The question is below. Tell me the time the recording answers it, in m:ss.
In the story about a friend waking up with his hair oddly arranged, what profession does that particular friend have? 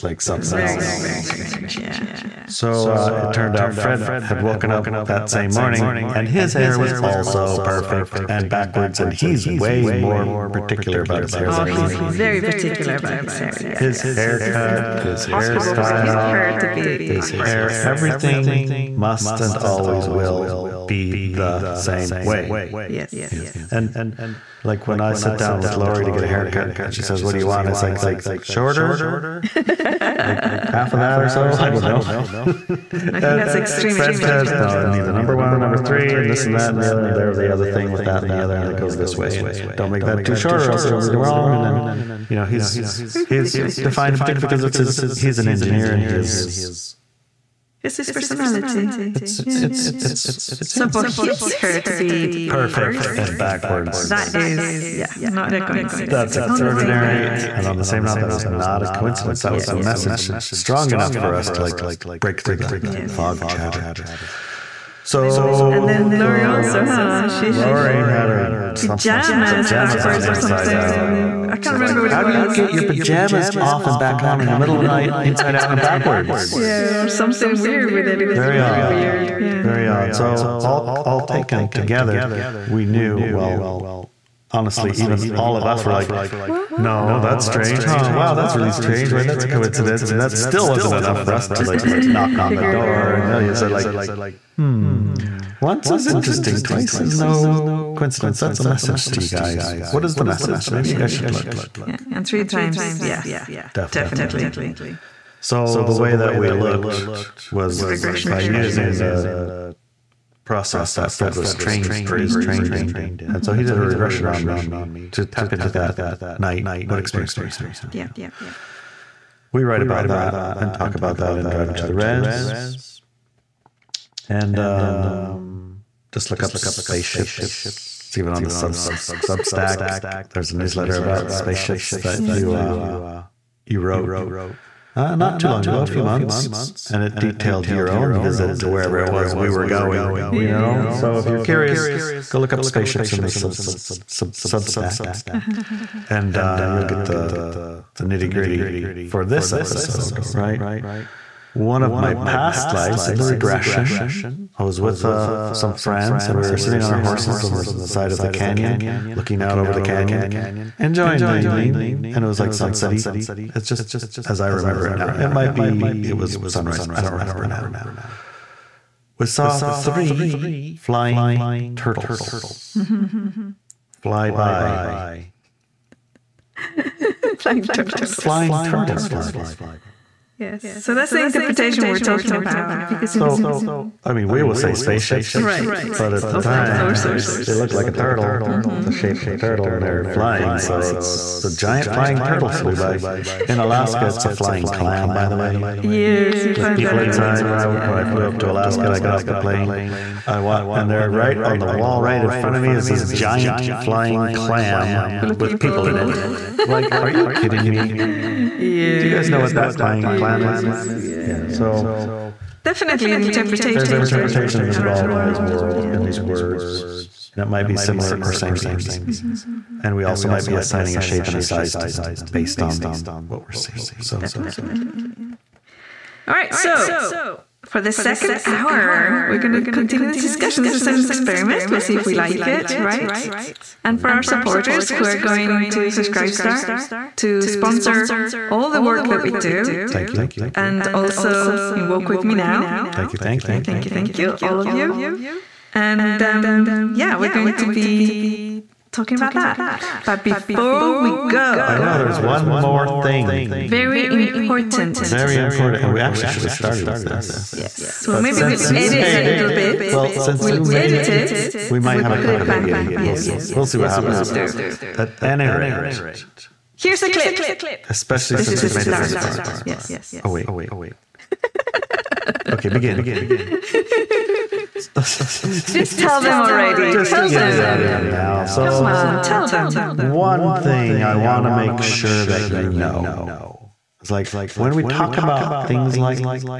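0:45.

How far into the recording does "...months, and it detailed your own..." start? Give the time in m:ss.
2:16.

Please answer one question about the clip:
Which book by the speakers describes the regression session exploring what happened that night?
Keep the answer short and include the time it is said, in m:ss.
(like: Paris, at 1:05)
Driving to the Rez, at 2:01.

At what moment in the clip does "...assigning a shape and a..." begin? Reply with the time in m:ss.
3:40.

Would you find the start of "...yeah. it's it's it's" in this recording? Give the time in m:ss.
0:49.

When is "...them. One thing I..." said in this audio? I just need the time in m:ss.
4:39.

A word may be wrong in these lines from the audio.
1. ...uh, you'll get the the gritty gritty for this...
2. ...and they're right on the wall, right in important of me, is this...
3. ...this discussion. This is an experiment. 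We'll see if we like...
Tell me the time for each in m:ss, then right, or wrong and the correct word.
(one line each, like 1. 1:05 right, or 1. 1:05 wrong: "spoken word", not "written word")
1. 2:26 wrong: "nitty", not "gritty"
2. 3:20 wrong: "front", not "important"
3. 3:50 right.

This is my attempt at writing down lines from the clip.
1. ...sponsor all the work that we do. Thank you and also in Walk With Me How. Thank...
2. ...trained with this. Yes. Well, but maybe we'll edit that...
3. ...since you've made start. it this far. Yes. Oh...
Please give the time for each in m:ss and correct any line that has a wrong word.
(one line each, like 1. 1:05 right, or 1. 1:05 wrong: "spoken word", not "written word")
1. 3:57 wrong: "Now", not "How"
2. 4:16 wrong: "started", not "trained"
3. 4:28 right.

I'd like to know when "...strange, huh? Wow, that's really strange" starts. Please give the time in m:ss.
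1:27.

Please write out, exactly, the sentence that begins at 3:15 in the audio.
Yes, you with find people that inside.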